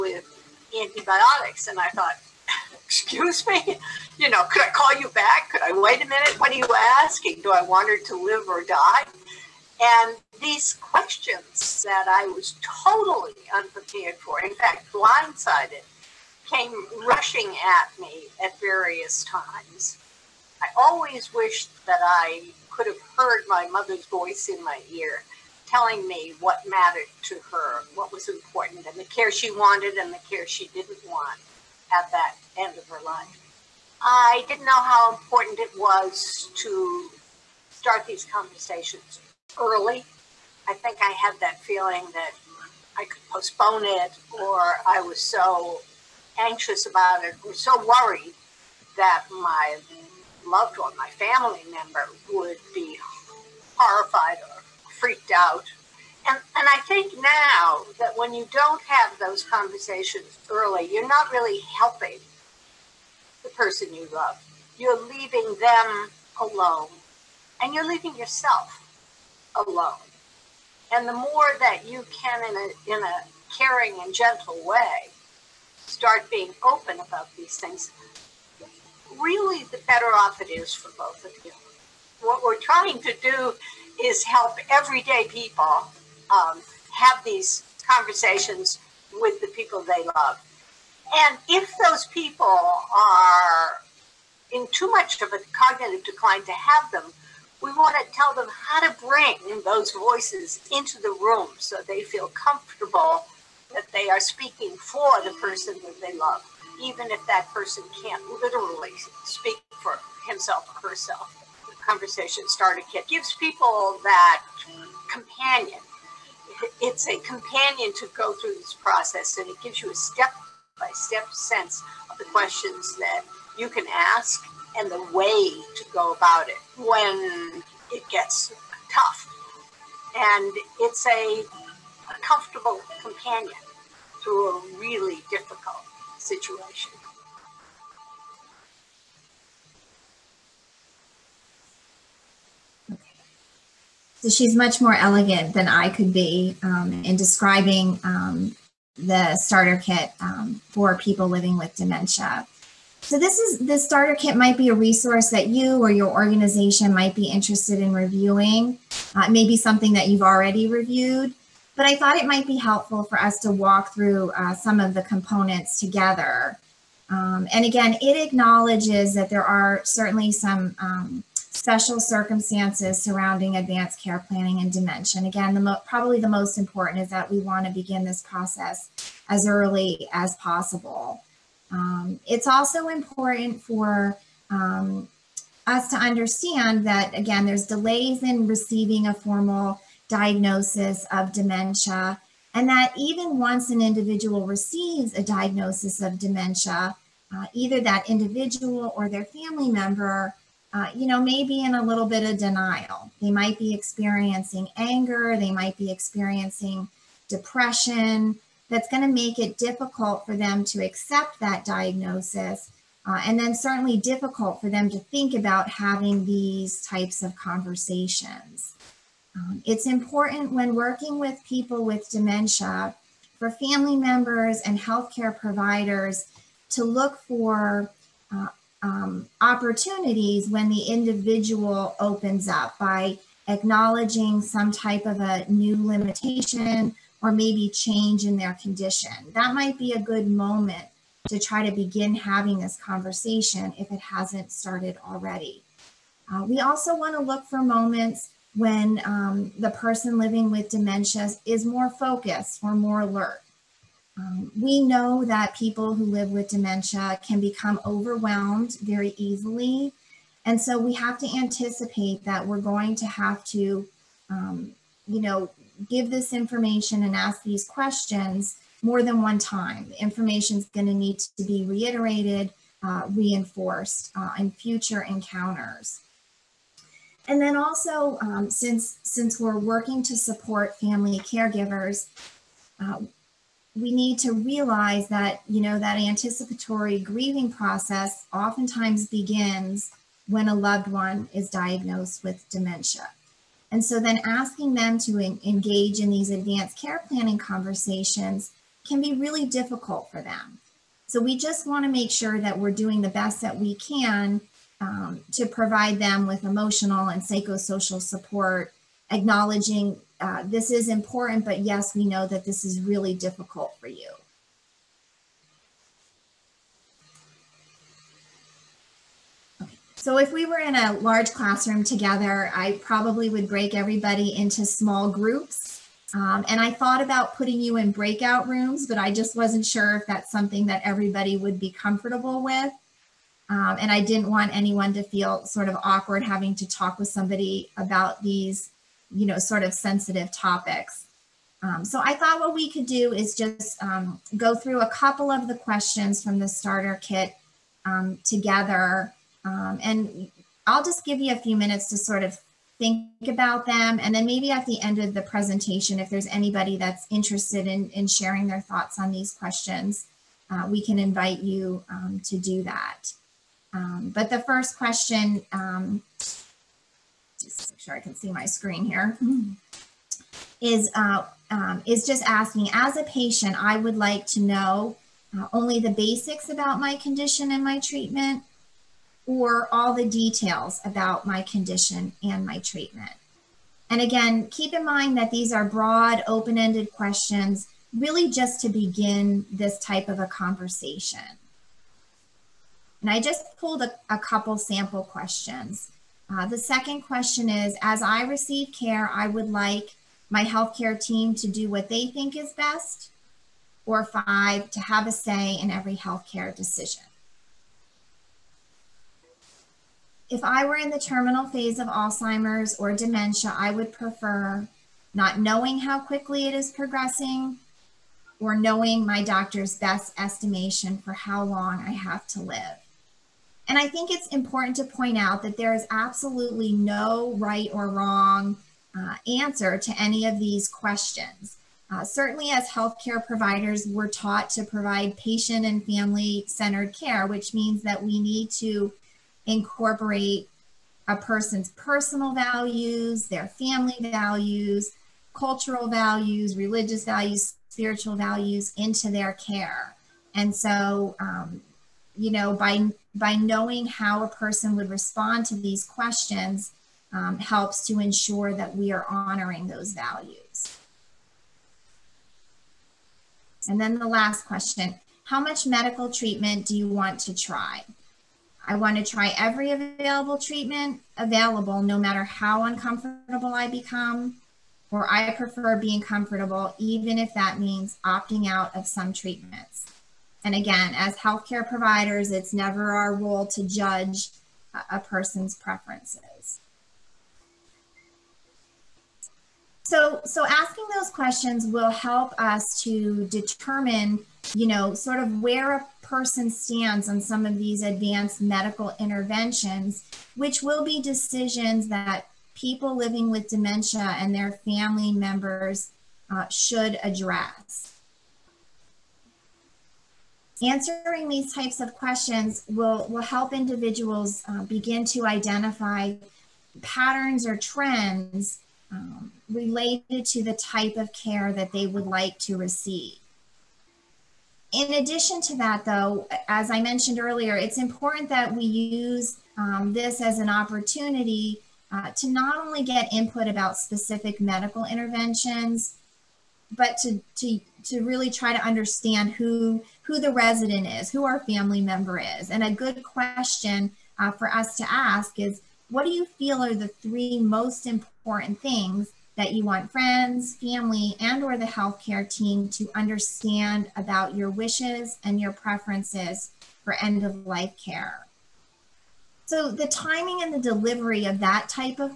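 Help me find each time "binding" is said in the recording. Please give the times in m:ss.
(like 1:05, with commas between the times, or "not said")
not said.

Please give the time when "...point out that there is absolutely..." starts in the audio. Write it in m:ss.
7:04.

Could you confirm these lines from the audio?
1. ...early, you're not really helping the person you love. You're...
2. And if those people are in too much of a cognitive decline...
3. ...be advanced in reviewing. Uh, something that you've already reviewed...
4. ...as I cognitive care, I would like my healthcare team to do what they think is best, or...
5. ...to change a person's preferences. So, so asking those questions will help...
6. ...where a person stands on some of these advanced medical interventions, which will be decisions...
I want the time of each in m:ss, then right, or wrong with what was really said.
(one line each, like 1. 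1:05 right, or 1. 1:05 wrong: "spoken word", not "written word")
1. 1:00 right
2. 1:31 right
3. 2:37 wrong: "interested", not "advanced"
4. 6:37 wrong: "receive", not "cognitive"
5. 8:03 wrong: "judge", not "change"
6. 8:15 right.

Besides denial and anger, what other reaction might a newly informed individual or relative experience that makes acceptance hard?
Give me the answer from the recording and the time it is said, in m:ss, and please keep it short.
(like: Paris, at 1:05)
depression, at 3:27.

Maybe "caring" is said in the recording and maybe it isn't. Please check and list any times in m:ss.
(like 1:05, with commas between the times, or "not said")
1:13.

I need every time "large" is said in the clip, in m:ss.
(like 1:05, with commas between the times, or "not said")
5:20.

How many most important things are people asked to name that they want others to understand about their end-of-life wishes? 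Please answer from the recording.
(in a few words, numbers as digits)
3.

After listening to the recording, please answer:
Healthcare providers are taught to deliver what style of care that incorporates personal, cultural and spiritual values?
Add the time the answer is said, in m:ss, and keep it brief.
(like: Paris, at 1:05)
patient and family centered care, at 7:15.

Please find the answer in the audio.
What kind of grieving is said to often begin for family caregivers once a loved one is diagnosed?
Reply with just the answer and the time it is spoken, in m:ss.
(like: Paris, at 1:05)
anticipatory grieving, at 4:45.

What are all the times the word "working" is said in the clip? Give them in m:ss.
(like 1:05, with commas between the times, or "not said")
3:40, 4:39.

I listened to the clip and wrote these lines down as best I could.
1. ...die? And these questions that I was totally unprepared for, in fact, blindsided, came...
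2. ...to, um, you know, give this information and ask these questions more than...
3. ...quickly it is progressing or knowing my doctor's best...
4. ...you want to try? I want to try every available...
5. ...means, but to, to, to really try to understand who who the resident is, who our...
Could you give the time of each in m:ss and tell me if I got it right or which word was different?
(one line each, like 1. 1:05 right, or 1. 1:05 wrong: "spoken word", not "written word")
1. 0:08 right
2. 4:23 right
3. 6:55 right
4. 7:46 right
5. 8:54 wrong: "interventions", not "means".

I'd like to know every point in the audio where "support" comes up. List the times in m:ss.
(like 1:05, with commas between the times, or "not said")
4:40, 5:08.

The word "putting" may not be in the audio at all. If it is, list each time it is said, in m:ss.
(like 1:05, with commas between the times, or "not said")
5:27.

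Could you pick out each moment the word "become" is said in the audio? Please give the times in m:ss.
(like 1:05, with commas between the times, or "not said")
4:17, 7:53.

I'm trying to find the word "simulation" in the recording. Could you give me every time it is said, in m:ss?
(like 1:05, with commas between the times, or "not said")
not said.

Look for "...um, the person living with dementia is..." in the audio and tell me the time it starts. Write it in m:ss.
4:09.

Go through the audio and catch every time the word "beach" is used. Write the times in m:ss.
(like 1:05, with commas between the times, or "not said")
not said.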